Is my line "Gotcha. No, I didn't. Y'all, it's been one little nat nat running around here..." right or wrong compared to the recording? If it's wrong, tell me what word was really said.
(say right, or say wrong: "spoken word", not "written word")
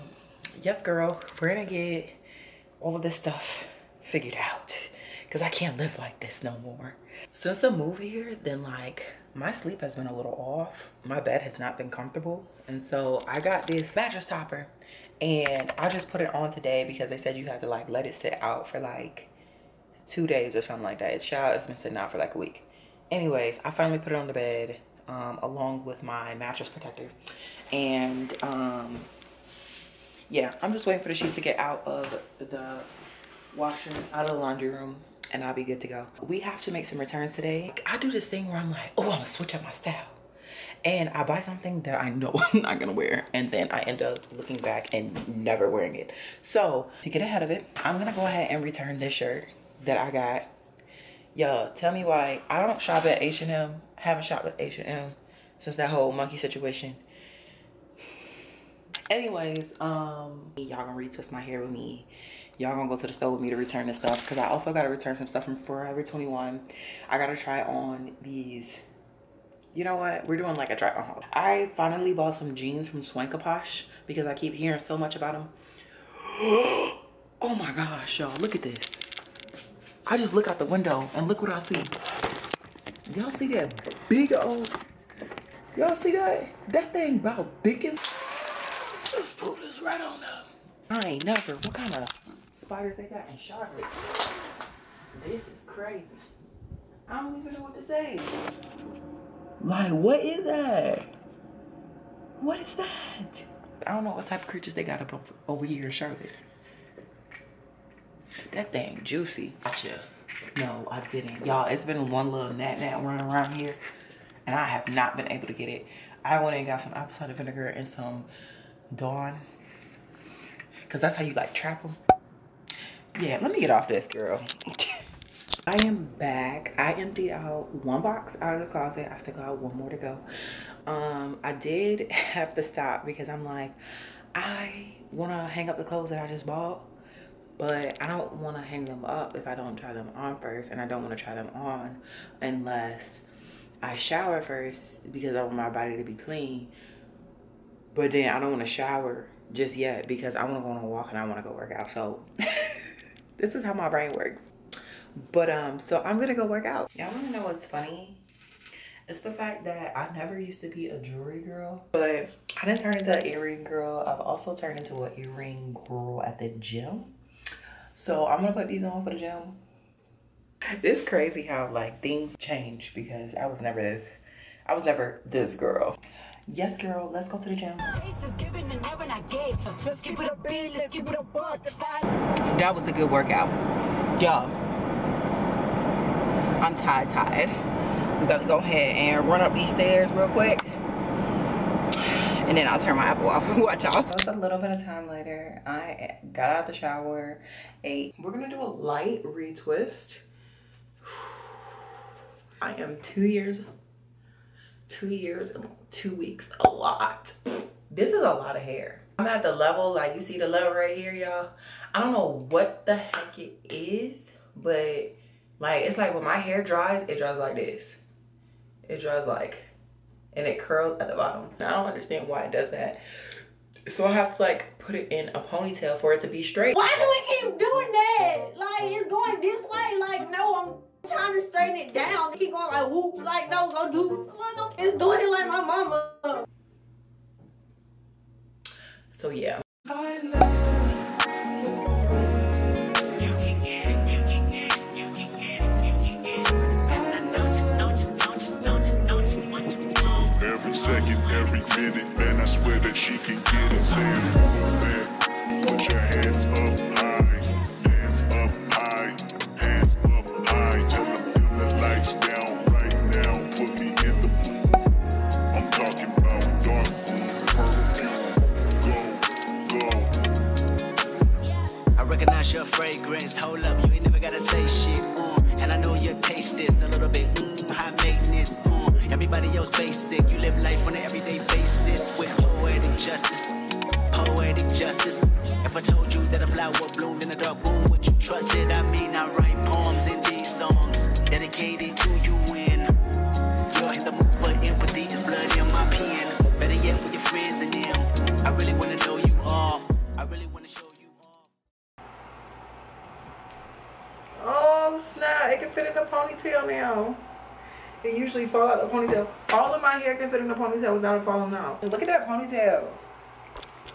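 right.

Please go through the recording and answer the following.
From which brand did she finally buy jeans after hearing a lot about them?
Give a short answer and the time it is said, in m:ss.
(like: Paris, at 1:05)
Swankaposh, at 1:13.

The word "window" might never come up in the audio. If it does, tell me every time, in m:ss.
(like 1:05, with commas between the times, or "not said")
1:20.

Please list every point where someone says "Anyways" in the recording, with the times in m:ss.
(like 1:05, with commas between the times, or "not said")
0:23, 0:59.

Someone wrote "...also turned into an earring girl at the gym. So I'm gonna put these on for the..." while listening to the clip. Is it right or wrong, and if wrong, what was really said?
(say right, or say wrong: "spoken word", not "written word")
right.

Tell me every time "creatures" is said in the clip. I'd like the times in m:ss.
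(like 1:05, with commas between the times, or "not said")
1:44.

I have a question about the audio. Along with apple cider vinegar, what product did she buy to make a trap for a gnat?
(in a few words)
Dawn.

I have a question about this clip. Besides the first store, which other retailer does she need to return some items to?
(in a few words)
Forever 21.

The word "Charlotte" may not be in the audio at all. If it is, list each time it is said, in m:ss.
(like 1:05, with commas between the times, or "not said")
1:33, 1:45.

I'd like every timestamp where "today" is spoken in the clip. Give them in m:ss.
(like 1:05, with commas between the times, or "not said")
0:16, 0:37.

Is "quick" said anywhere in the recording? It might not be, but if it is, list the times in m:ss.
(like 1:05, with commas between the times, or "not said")
3:10.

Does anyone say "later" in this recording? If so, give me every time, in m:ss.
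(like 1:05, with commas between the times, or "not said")
3:15.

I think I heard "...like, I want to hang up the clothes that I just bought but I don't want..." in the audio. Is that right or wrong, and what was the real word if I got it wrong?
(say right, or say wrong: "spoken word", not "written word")
right.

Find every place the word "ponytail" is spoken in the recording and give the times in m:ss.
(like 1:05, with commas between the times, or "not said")
3:45, 5:12.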